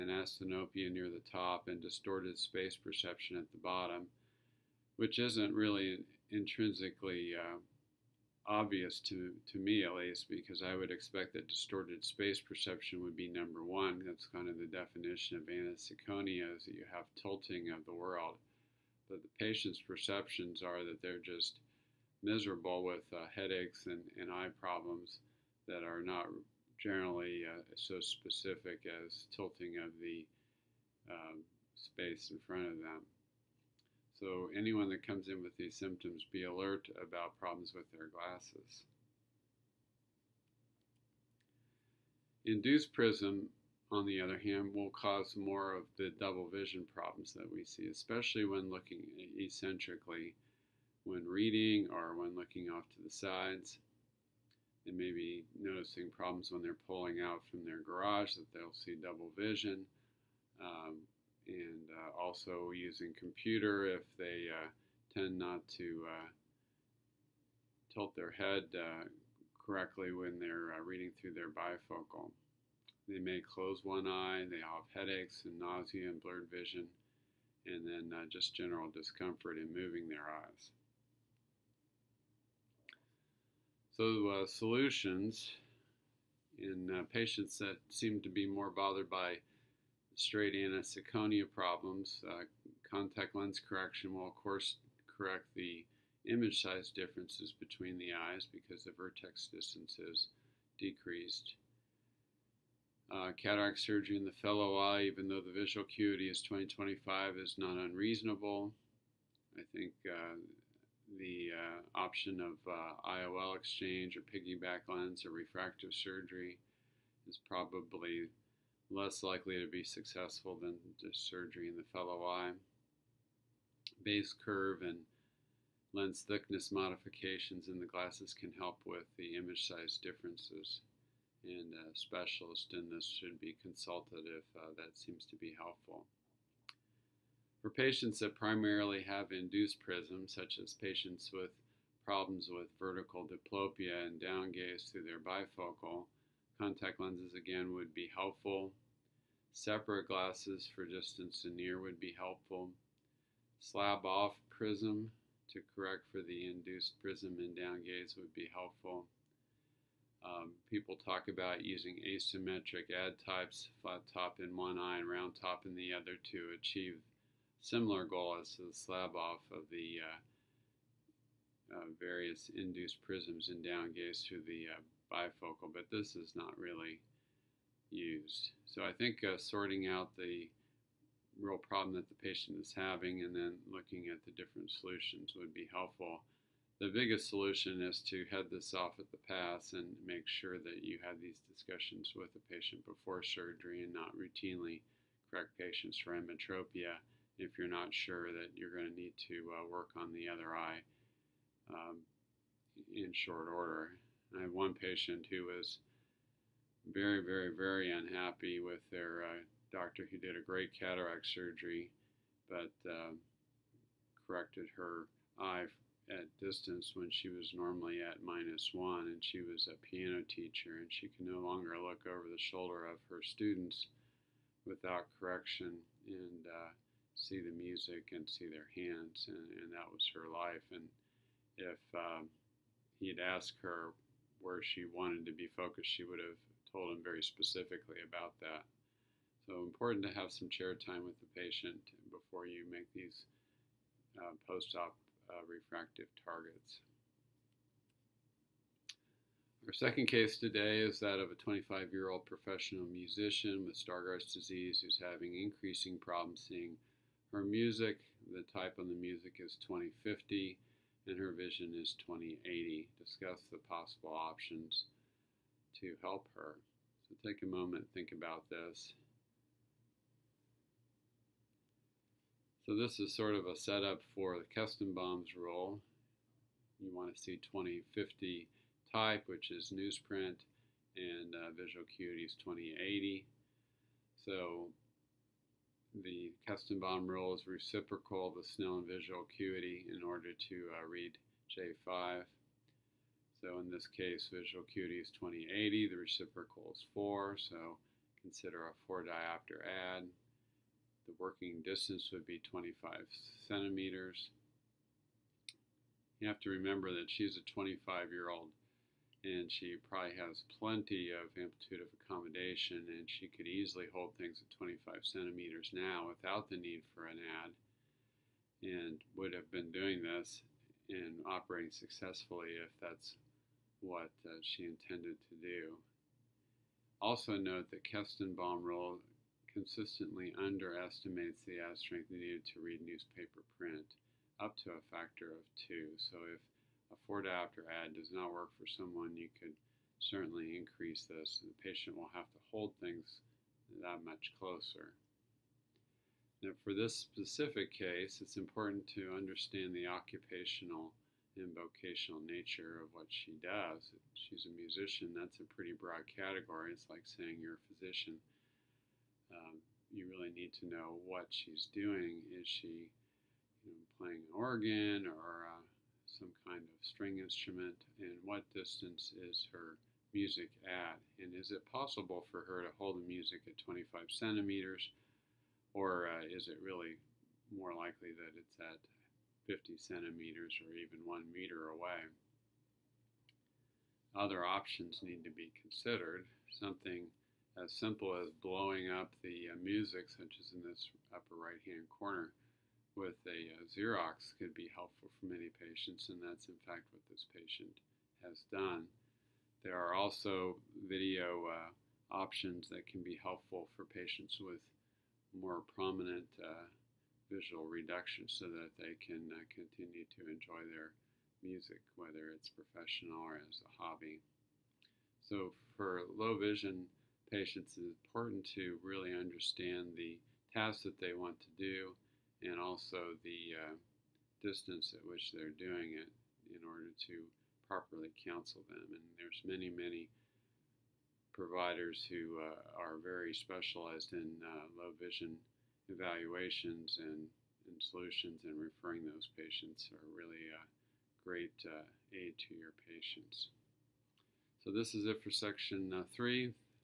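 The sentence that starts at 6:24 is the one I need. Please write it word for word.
Other options need to be considered.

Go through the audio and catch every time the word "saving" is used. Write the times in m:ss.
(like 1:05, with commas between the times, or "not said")
not said.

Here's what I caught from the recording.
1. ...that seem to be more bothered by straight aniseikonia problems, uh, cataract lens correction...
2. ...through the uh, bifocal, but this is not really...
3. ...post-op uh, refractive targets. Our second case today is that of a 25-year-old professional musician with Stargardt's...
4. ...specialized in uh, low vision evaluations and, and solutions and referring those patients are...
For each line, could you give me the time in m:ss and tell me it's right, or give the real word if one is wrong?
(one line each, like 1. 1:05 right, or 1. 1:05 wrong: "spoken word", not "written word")
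1. 1:27 wrong: "contact", not "cataract"
2. 2:54 right
3. 4:04 right
4. 7:13 right.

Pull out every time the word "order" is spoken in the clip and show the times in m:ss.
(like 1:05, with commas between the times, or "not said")
3:23, 4:50, 7:06.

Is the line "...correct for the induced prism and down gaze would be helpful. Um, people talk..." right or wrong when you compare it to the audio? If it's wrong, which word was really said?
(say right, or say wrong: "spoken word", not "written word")
right.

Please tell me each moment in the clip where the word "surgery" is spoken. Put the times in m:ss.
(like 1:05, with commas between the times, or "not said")
1:43, 1:55, 2:01, 3:13, 3:31.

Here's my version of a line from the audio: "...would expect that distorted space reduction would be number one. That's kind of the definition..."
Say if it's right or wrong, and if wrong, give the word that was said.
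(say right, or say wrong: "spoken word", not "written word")
wrong: "perception", not "reduction".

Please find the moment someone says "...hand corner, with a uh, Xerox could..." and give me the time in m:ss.
6:31.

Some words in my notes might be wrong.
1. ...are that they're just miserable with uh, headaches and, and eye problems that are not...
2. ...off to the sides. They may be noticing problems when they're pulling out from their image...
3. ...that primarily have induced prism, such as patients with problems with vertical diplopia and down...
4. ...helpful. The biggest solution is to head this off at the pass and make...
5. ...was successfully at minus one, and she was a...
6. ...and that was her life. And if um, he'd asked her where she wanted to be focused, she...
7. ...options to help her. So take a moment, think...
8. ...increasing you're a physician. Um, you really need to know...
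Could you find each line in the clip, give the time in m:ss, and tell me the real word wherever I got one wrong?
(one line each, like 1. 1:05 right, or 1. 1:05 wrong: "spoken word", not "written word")
1. 0:20 right
2. 0:52 wrong: "garage", not "image"
3. 2:18 right
4. 3:05 right
5. 3:37 wrong: "normally", not "successfully"
6. 3:49 right
7. 4:24 right
8. 5:57 wrong: "saying", not "increasing".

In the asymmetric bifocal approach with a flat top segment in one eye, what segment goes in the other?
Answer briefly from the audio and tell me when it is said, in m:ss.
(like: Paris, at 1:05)
round top, at 2:45.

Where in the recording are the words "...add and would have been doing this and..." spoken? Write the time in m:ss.
5:17.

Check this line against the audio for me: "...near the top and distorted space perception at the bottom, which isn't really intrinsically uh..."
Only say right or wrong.
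right.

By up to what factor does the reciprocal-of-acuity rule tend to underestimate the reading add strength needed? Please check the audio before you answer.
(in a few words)
2.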